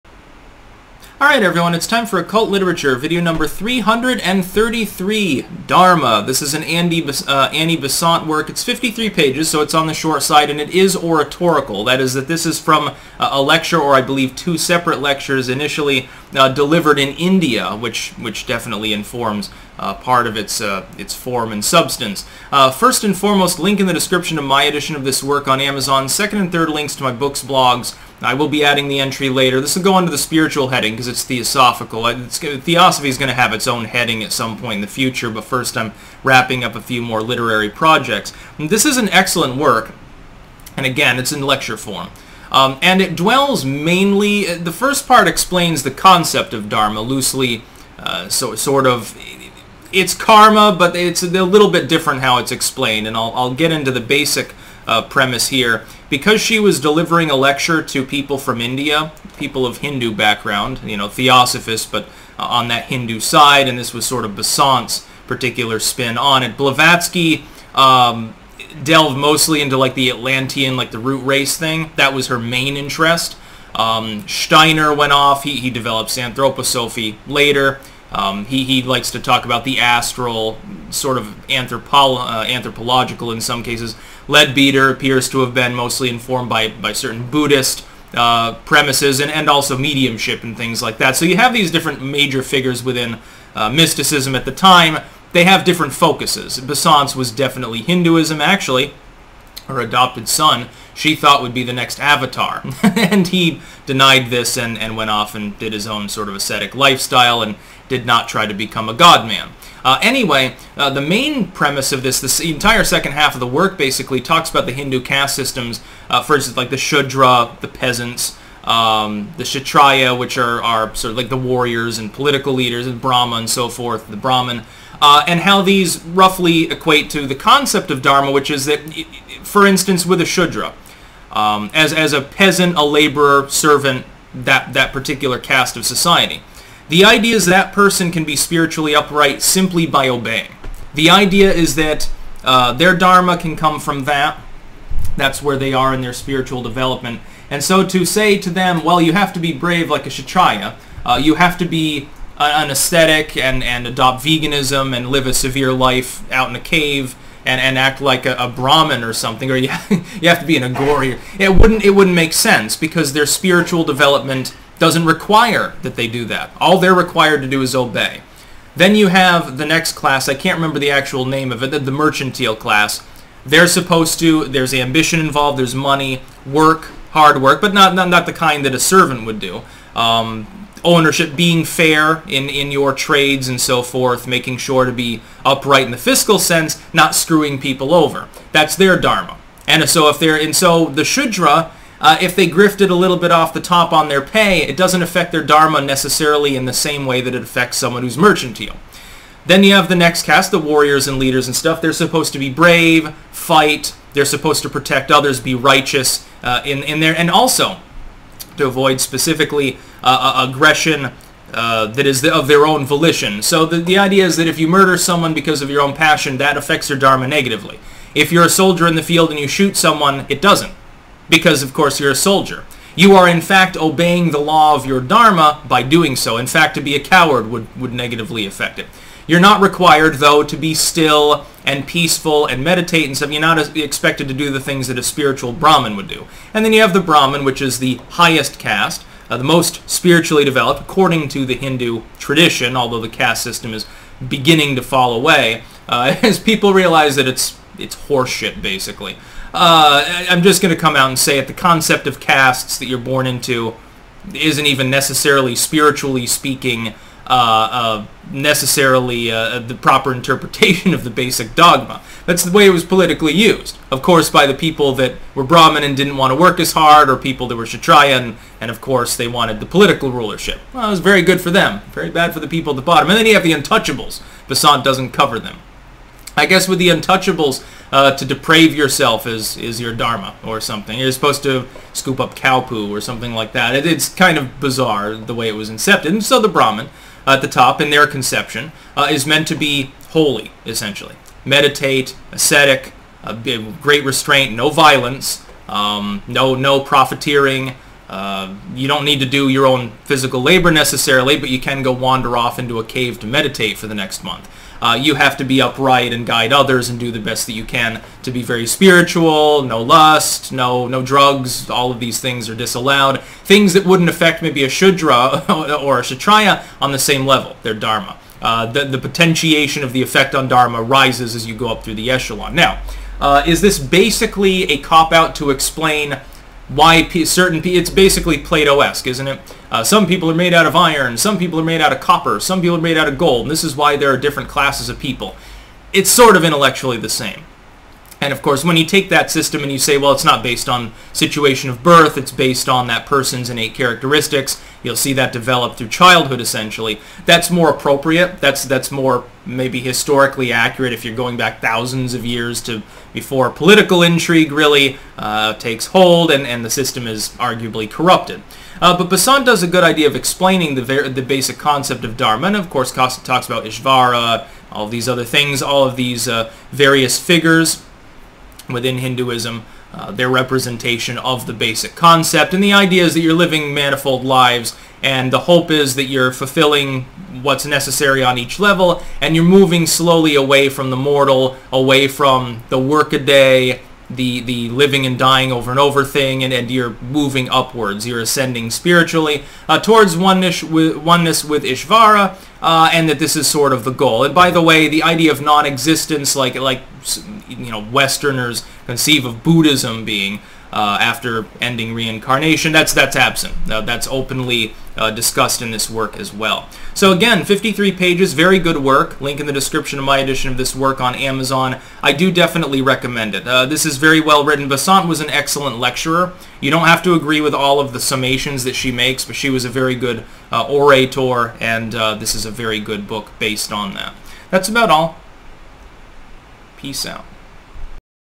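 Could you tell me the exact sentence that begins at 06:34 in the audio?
And by the way, the idea of non-existence, like like you know Westerners conceive of Buddhism being uh, after ending reincarnation.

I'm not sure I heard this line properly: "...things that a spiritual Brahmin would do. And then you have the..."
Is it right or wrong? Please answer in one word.
right.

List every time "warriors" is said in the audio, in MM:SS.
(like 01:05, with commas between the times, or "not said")
02:01, 03:20.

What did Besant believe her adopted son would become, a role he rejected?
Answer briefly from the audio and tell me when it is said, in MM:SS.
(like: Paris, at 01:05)
the next avatar, at 01:41.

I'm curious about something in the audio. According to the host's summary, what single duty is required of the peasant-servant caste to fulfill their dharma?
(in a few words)
Obey.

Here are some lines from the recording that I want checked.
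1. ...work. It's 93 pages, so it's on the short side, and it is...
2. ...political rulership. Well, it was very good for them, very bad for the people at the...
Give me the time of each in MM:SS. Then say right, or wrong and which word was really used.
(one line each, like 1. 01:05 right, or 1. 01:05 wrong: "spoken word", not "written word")
1. 00:08 wrong: "53", not "93"
2. 04:29 right.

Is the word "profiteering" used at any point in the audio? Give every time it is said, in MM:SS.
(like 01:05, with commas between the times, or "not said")
04:56.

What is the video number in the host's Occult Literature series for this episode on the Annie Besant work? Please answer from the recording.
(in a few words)
333.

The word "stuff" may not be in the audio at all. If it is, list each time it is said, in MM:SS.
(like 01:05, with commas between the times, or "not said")
03:21, 03:53.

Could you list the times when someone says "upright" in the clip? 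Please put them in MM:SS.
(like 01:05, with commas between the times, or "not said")
02:18, 03:05, 05:05.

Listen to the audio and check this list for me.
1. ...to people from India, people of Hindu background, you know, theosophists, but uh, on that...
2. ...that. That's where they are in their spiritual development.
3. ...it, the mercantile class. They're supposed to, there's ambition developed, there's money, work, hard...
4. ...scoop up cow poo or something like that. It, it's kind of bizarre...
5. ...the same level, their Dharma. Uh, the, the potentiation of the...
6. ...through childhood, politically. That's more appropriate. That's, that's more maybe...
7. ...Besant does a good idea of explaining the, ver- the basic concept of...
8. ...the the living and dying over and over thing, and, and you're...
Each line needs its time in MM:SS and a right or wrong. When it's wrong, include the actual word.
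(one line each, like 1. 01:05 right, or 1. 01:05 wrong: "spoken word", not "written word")
1. 00:57 right
2. 02:24 right
3. 02:51 wrong: "involved", not "developed"
4. 04:41 right
5. 05:16 right
6. 05:45 wrong: "essentially", not "politically"
7. 05:59 right
8. 06:24 right.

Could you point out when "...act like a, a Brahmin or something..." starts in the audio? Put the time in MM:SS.
02:37.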